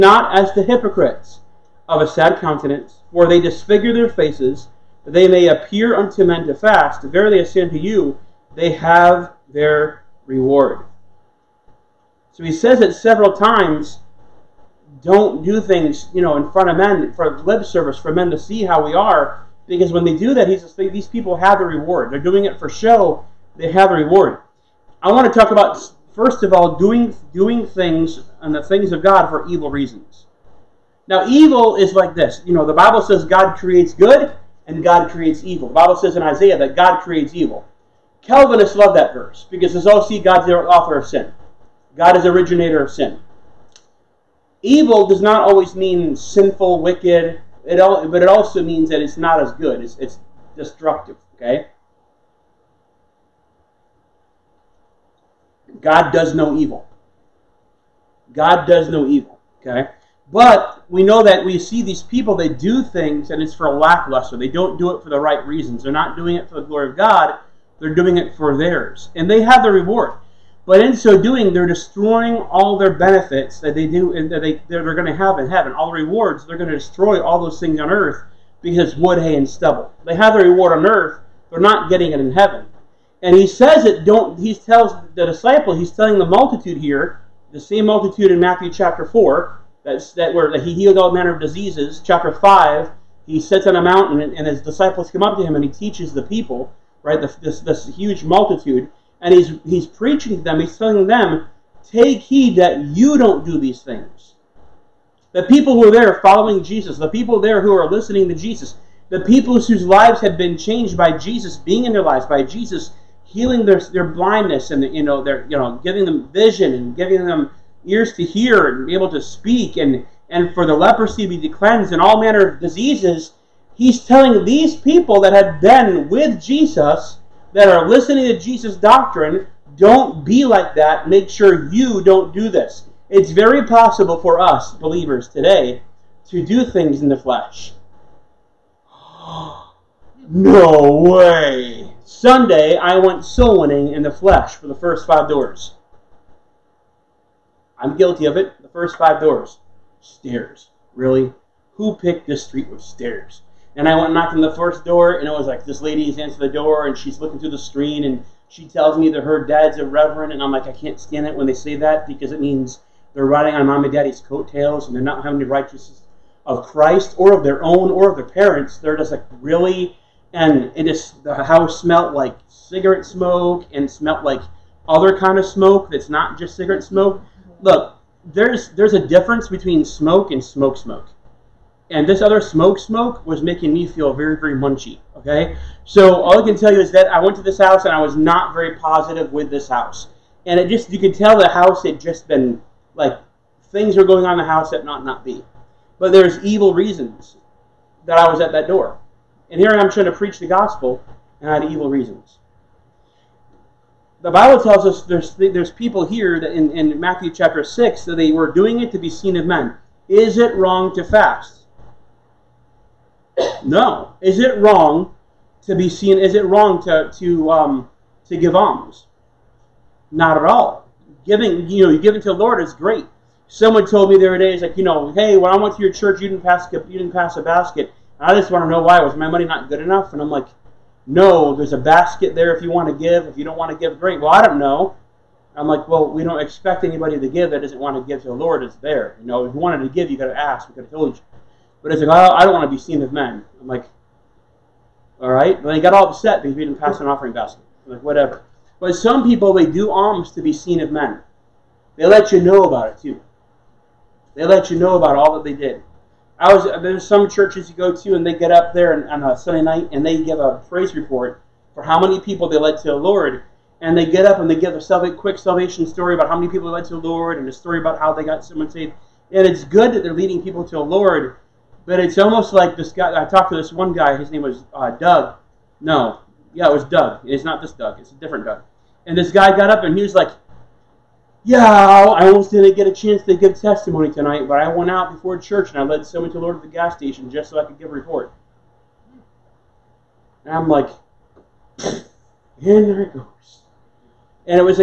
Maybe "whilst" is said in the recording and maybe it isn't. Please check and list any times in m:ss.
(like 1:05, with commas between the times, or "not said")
not said.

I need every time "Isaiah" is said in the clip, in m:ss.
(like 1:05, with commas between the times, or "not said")
0:36.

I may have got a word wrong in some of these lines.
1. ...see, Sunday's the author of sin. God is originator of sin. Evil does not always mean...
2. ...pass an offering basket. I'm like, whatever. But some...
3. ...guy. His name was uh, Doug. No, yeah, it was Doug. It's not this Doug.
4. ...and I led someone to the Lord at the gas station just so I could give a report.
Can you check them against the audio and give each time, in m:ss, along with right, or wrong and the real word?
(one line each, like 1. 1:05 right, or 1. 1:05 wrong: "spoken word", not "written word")
1. 0:40 wrong: "God", not "Sunday"
2. 4:06 right
3. 4:33 right
4. 4:45 right.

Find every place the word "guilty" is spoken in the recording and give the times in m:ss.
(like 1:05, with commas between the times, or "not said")
2:27.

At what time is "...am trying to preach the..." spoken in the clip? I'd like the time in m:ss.
3:19.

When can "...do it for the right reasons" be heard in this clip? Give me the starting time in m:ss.
1:04.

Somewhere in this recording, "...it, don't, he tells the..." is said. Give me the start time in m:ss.
1:23.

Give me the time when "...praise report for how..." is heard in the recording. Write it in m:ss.
4:20.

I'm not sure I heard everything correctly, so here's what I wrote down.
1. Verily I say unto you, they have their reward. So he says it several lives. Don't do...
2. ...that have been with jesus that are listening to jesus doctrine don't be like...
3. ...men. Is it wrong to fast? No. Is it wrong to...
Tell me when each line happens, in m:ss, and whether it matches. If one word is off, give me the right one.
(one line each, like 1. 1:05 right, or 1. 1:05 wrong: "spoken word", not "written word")
1. 0:07 wrong: "times", not "lives"
2. 2:05 right
3. 3:29 right.